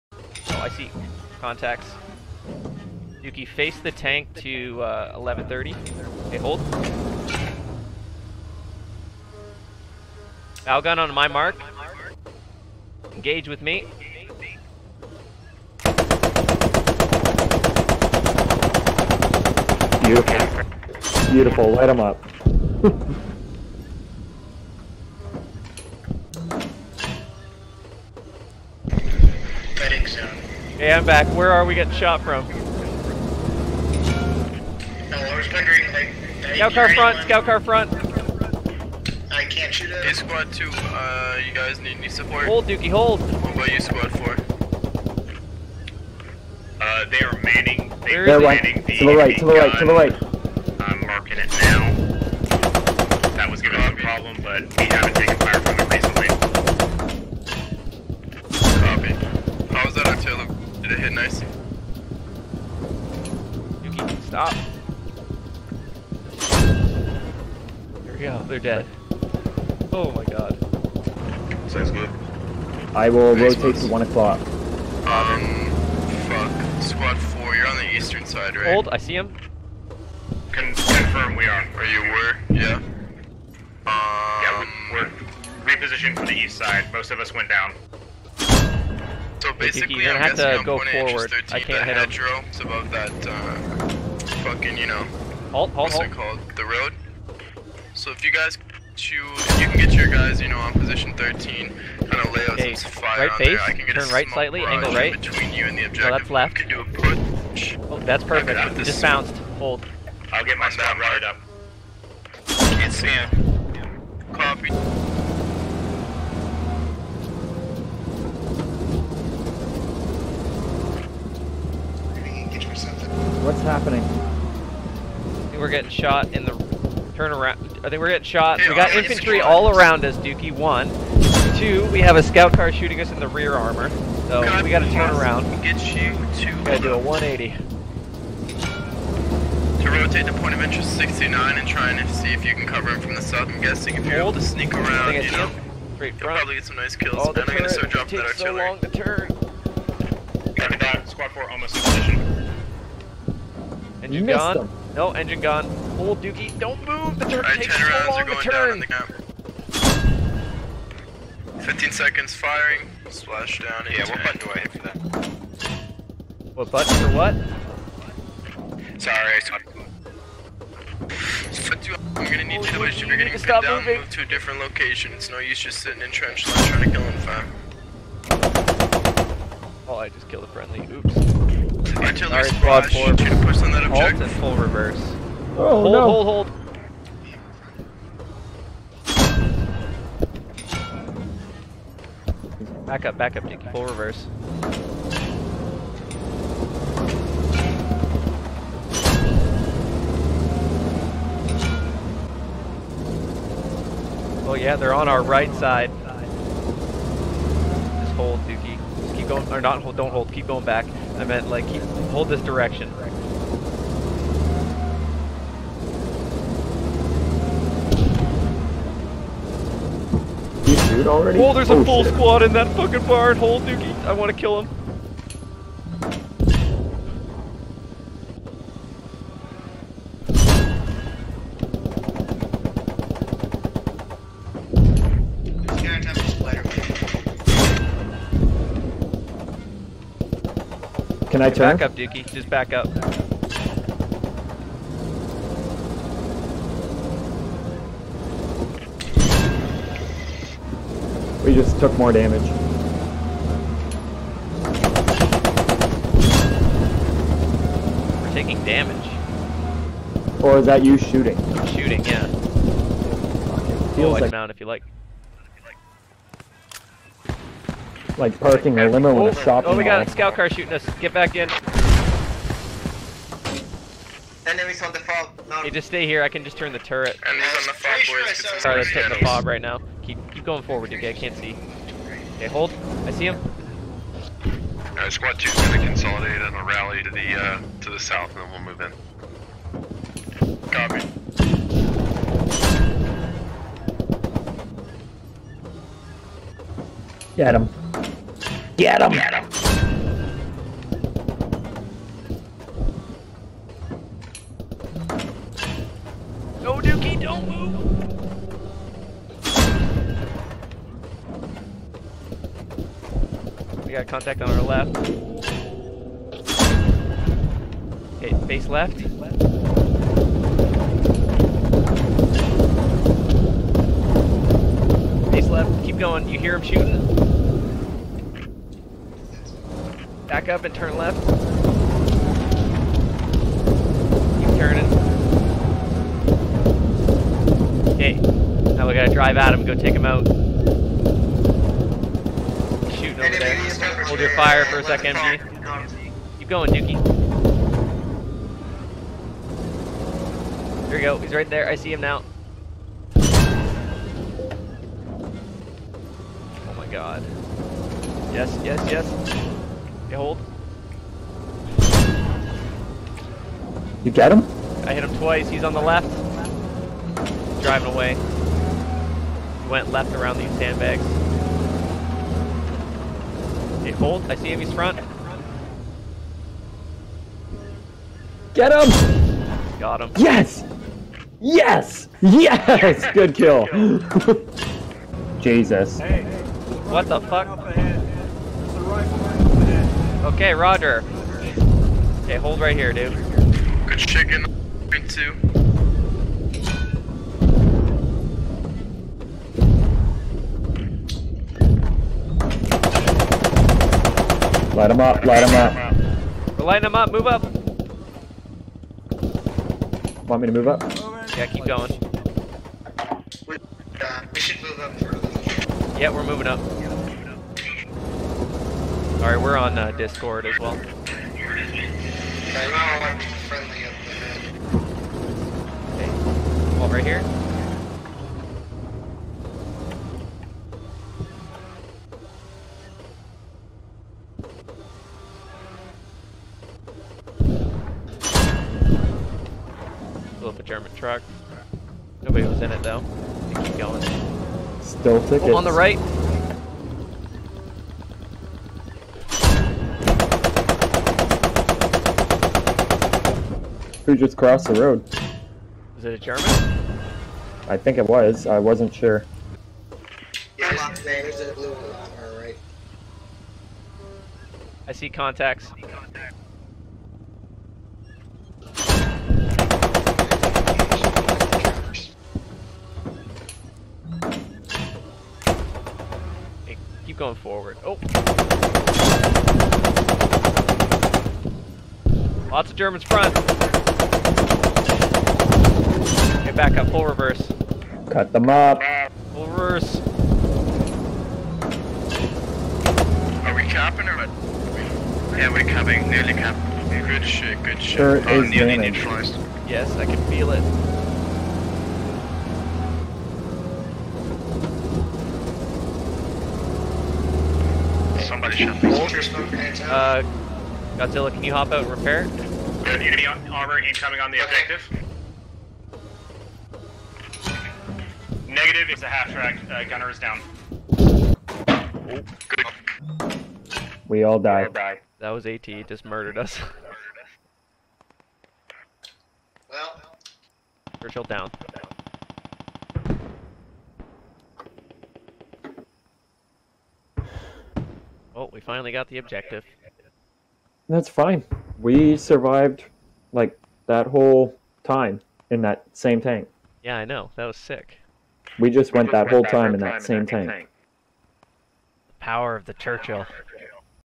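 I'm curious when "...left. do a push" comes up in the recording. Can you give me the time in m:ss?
1:46.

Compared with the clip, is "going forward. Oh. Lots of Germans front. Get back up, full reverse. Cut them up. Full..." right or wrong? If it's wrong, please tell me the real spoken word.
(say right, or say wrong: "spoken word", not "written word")
right.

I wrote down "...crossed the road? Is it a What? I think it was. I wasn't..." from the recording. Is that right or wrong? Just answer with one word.
wrong.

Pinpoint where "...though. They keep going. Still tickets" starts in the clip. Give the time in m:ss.
7:22.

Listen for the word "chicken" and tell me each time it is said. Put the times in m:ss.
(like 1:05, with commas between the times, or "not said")
6:33.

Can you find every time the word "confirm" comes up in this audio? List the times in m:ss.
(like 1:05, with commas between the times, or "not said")
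1:20.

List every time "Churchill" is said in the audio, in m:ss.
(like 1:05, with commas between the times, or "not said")
8:51, 9:12.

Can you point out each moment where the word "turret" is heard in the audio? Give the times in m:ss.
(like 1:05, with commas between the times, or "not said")
2:37, 4:36.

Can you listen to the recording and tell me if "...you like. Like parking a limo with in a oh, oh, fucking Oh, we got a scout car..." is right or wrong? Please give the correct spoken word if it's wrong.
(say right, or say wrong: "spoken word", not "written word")
wrong: "shopping", not "fucking".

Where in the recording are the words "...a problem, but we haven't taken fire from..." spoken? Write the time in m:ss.
0:53.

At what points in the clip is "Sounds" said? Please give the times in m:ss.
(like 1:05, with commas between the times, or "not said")
1:11.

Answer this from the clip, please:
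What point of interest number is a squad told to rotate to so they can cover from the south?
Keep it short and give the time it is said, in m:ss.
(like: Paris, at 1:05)
69, at 2:20.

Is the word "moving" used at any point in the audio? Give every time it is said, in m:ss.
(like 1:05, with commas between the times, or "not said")
2:53, 6:56.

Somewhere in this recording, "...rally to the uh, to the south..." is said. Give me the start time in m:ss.
4:46.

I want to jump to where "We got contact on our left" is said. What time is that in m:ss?
5:13.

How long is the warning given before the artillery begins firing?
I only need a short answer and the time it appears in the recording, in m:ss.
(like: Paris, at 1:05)
15 seconds, at 2:41.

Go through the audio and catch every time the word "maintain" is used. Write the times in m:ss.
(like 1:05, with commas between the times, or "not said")
not said.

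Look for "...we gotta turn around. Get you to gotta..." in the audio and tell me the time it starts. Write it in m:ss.
2:14.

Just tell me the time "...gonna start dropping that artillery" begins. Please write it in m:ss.
2:27.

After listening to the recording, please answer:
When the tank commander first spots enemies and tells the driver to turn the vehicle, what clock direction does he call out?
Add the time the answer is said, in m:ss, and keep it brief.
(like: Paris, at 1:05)
11:30, at 0:05.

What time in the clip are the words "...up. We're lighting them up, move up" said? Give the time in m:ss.
6:45.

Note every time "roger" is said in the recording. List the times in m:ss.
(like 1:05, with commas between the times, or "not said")
6:30.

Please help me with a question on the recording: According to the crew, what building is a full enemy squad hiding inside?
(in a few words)
Barn.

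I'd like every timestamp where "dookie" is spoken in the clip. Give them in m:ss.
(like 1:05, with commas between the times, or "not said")
0:42, 2:10, 2:36, 3:28, 3:43, 4:01.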